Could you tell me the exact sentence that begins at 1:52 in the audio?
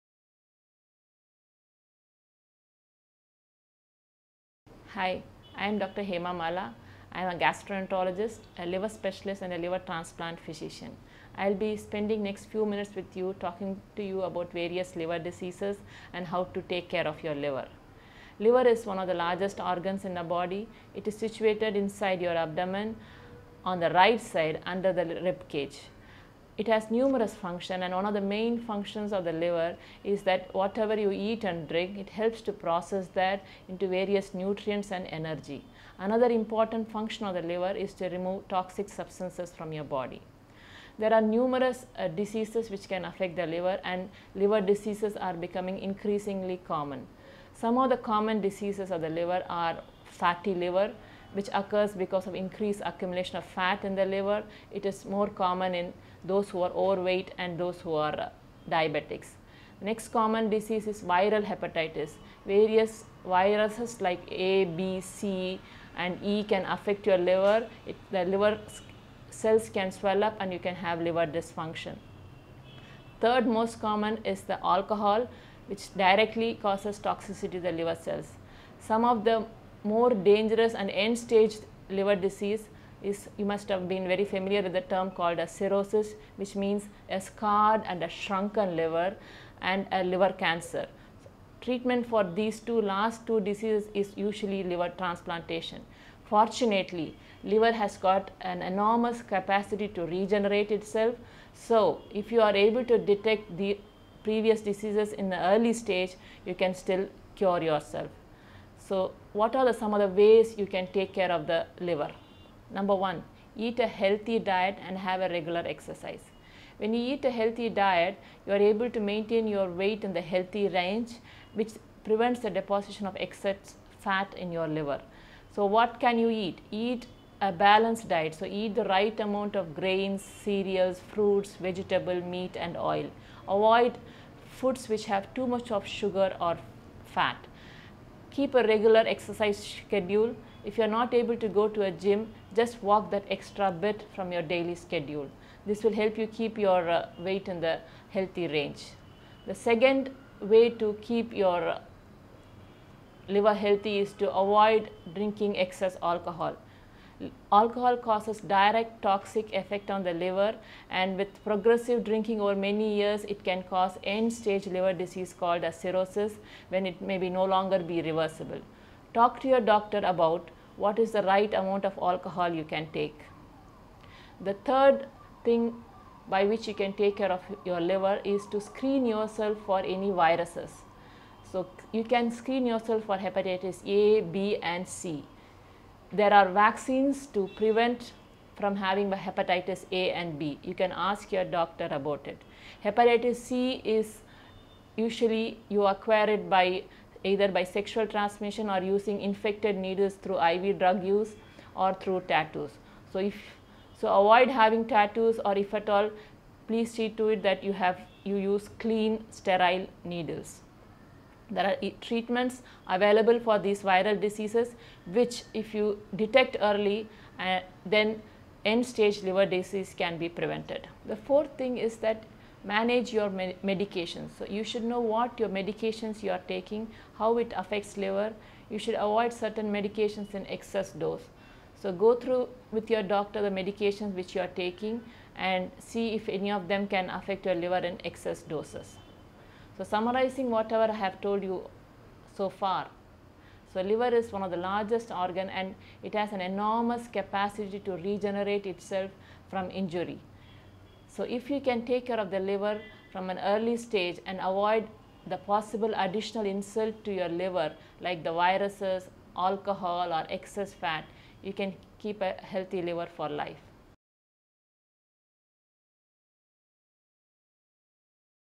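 Number one, eat a healthy diet and have a regular exercise.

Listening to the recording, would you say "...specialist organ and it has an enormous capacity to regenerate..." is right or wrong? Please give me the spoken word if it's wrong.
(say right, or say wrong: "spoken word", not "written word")
wrong: "largest", not "specialist".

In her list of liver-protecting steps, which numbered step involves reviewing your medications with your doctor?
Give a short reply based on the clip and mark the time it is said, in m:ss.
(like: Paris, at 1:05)
4th, at 3:41.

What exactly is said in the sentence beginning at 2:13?
Avoid foods which have too much of sugar or fat keep a regular exercise schedule.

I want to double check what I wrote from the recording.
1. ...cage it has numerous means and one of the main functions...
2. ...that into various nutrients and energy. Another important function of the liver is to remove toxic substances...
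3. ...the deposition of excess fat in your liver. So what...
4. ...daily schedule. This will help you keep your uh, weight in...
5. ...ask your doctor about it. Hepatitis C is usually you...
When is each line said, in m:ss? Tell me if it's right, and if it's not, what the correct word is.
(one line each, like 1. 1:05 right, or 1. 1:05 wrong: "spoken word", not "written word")
1. 0:25 wrong: "functions", not "means"
2. 0:33 right
3. 2:02 right
4. 2:24 right
5. 3:10 right.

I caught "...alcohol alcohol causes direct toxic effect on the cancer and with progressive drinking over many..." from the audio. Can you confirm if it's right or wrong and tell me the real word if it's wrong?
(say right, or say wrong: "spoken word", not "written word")
wrong: "liver", not "cancer".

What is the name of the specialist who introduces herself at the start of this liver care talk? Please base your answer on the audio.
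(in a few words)
Dr. Hema Mala.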